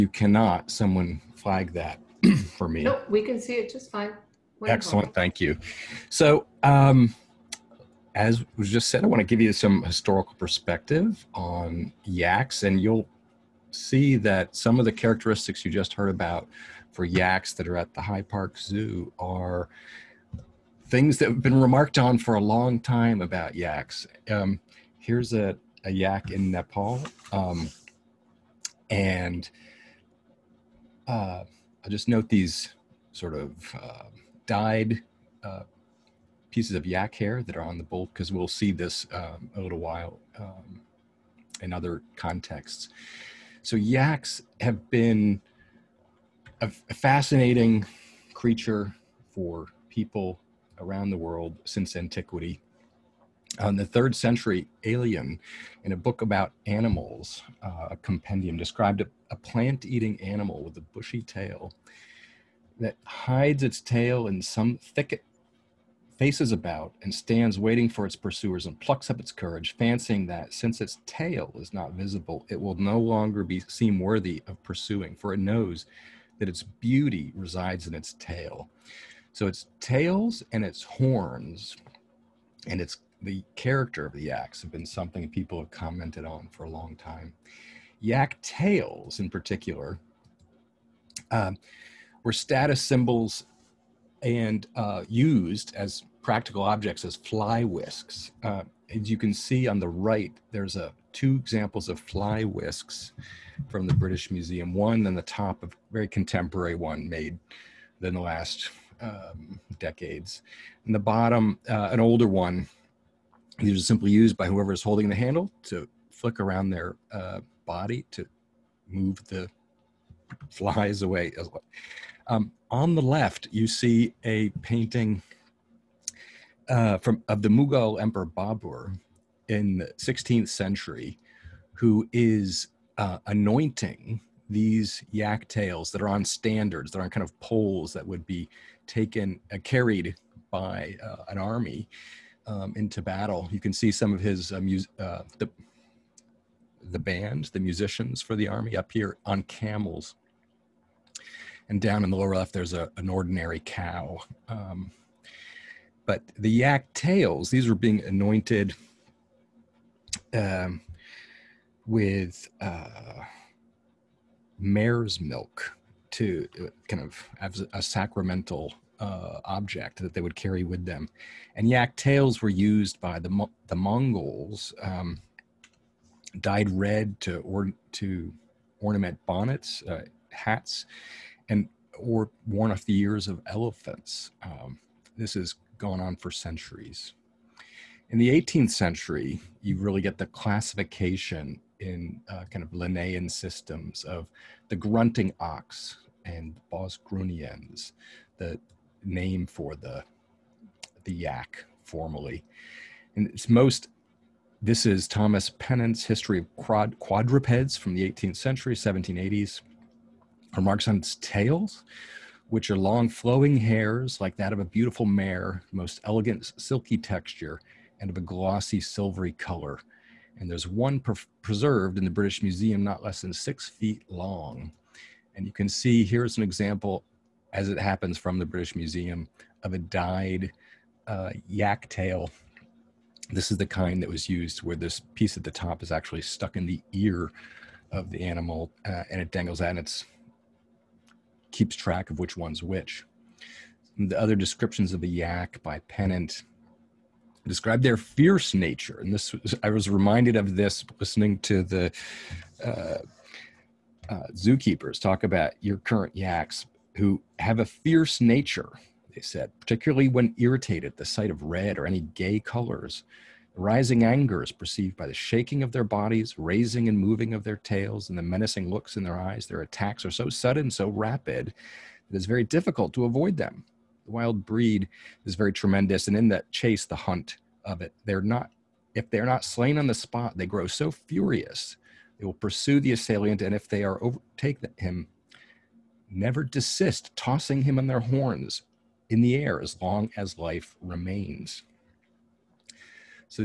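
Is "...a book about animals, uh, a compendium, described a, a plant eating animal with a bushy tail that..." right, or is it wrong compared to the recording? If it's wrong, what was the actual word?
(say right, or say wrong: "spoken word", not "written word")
right.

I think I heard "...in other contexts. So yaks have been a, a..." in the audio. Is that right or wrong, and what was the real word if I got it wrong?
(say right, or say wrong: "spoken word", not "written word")
right.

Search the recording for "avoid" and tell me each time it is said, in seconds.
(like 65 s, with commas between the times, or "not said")
273 s.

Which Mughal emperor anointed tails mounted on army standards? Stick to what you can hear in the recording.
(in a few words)
Babur.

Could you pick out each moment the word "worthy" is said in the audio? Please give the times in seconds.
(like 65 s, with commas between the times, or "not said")
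73 s.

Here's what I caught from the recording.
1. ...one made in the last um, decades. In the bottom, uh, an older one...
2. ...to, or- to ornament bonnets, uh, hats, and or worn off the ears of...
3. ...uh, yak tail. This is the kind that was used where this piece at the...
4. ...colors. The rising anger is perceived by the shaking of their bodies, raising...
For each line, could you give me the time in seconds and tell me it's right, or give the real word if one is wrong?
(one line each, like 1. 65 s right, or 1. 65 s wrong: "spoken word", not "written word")
1. 106 s right
2. 177 s right
3. 231 s right
4. 262 s right.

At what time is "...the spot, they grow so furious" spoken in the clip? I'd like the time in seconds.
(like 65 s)
279 s.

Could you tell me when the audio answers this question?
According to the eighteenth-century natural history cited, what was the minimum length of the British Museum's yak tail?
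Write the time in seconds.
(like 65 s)
223 s.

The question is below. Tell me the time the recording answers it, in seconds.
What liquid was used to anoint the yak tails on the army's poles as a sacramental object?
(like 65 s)
164 s.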